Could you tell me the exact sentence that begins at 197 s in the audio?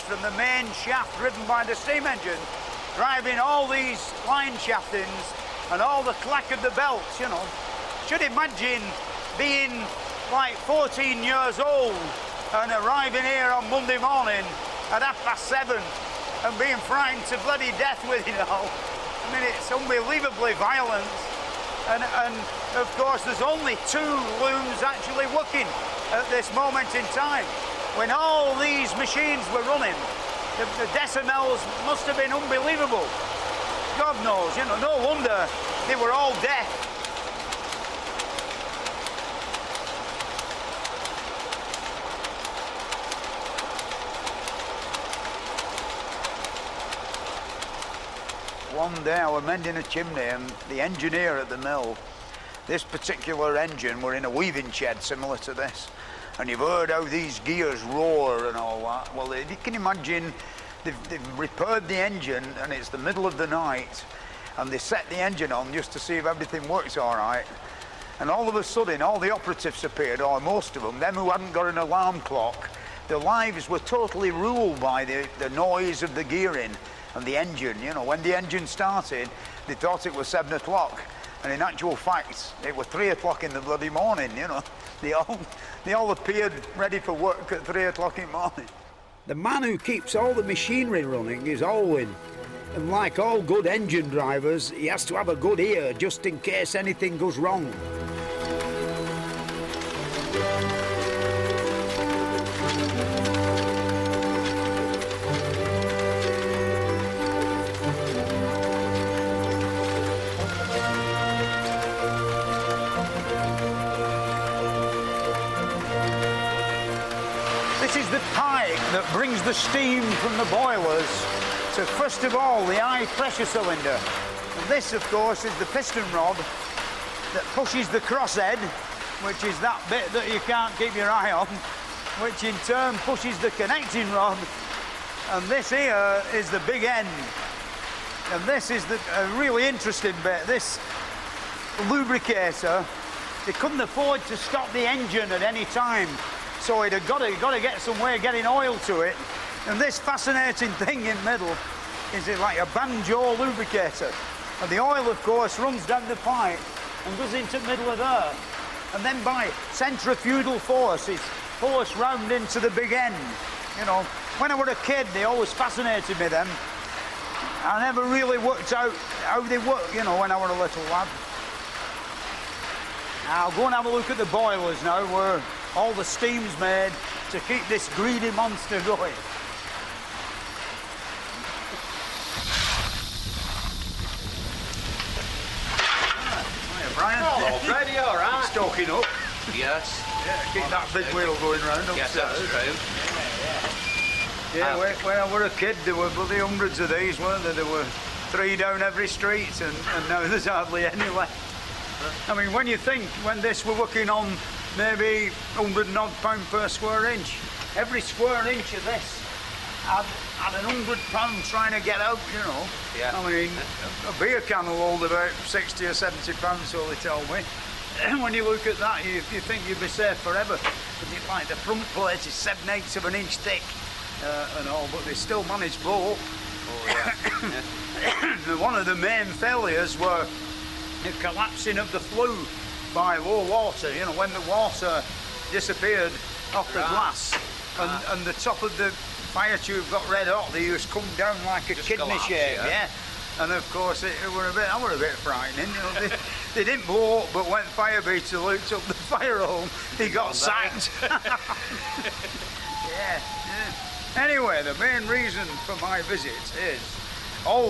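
There were three down every street, and, and now there's hardly any left.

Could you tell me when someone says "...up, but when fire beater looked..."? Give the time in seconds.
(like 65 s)
247 s.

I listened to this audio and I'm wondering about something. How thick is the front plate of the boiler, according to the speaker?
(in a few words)
7/8 of an inch.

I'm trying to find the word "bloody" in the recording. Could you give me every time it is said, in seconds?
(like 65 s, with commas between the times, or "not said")
17 s, 83 s, 196 s.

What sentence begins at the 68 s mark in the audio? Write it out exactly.
And all of a sudden, all the operatives appeared, or most of them, them who hadn't got an alarm clock.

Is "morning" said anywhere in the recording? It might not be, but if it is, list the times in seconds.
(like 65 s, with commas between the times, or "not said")
13 s, 83 s, 88 s.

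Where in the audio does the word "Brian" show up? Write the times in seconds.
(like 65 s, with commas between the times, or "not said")
186 s.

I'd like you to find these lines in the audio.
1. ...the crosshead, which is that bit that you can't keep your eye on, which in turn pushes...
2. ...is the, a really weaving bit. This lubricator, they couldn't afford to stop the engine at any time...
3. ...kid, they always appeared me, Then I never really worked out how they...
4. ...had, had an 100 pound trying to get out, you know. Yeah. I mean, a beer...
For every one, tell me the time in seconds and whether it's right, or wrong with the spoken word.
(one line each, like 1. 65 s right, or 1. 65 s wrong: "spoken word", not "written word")
1. 127 s right
2. 138 s wrong: "interesting", not "weaving"
3. 164 s wrong: "fascinated", not "appeared"
4. 209 s right.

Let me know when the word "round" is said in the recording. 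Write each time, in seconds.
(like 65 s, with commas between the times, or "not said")
161 s, 191 s.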